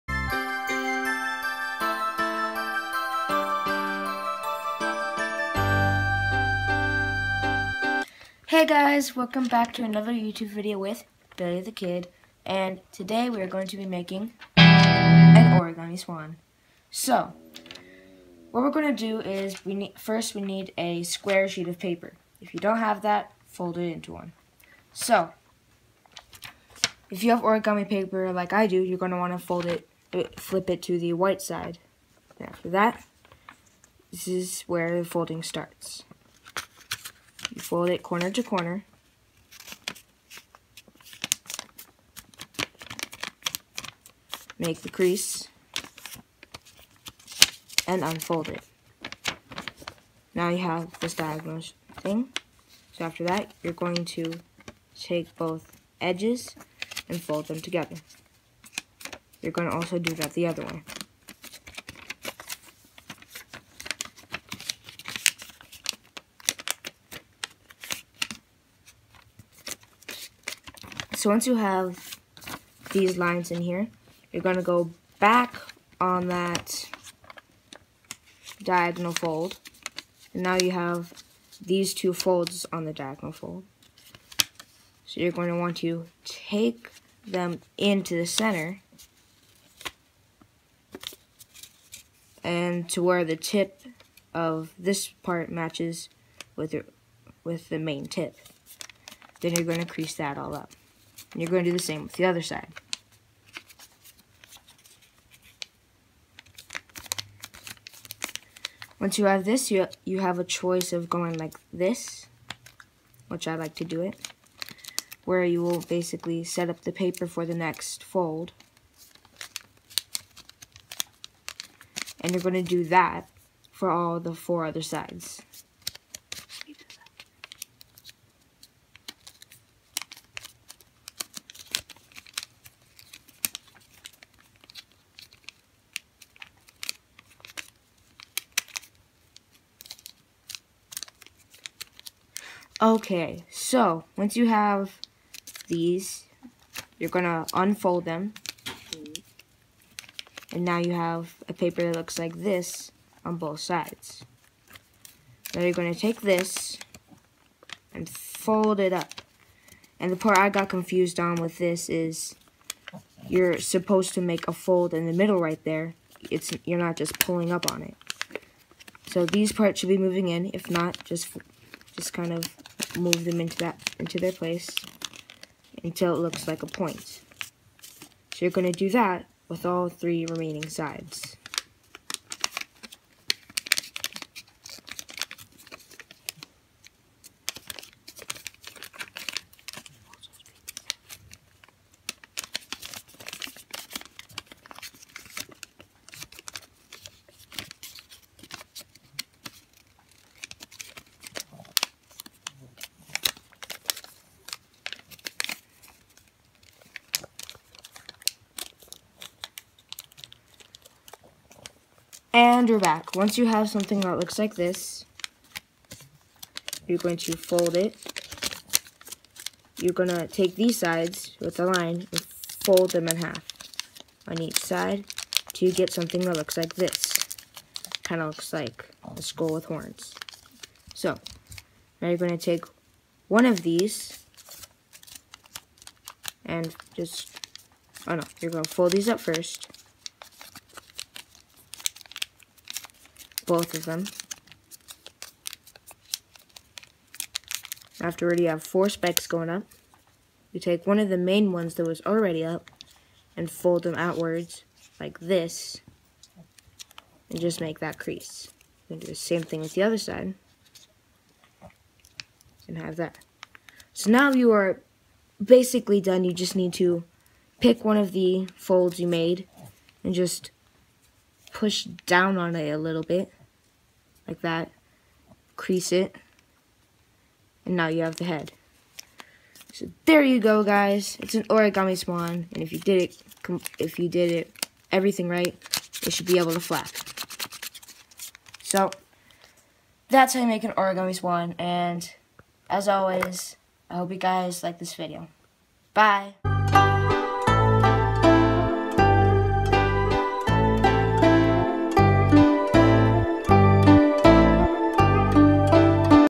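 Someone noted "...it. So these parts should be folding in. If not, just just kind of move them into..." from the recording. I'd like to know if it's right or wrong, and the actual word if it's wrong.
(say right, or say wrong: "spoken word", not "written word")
wrong: "moving", not "folding".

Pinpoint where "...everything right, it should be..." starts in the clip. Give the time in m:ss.
4:44.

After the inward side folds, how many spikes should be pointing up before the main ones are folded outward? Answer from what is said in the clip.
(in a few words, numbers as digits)
4.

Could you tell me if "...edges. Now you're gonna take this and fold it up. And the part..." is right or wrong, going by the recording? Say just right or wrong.
wrong.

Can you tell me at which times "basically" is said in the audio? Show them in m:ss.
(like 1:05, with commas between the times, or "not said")
1:55, 4:25.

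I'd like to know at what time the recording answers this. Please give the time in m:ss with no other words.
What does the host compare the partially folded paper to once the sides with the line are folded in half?
3:49.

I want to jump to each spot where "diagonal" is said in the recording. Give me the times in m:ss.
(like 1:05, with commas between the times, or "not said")
0:51, 1:18, 1:22.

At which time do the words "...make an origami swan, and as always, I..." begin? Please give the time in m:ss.
4:50.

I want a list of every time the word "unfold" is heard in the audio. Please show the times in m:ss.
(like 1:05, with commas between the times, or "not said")
0:48, 2:27.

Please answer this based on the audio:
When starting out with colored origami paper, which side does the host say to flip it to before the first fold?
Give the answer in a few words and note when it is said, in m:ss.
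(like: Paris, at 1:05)
the white side, at 0:30.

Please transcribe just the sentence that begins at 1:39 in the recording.
Then you're going to crease that all up.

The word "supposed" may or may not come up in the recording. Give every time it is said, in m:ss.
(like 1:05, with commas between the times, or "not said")
2:43.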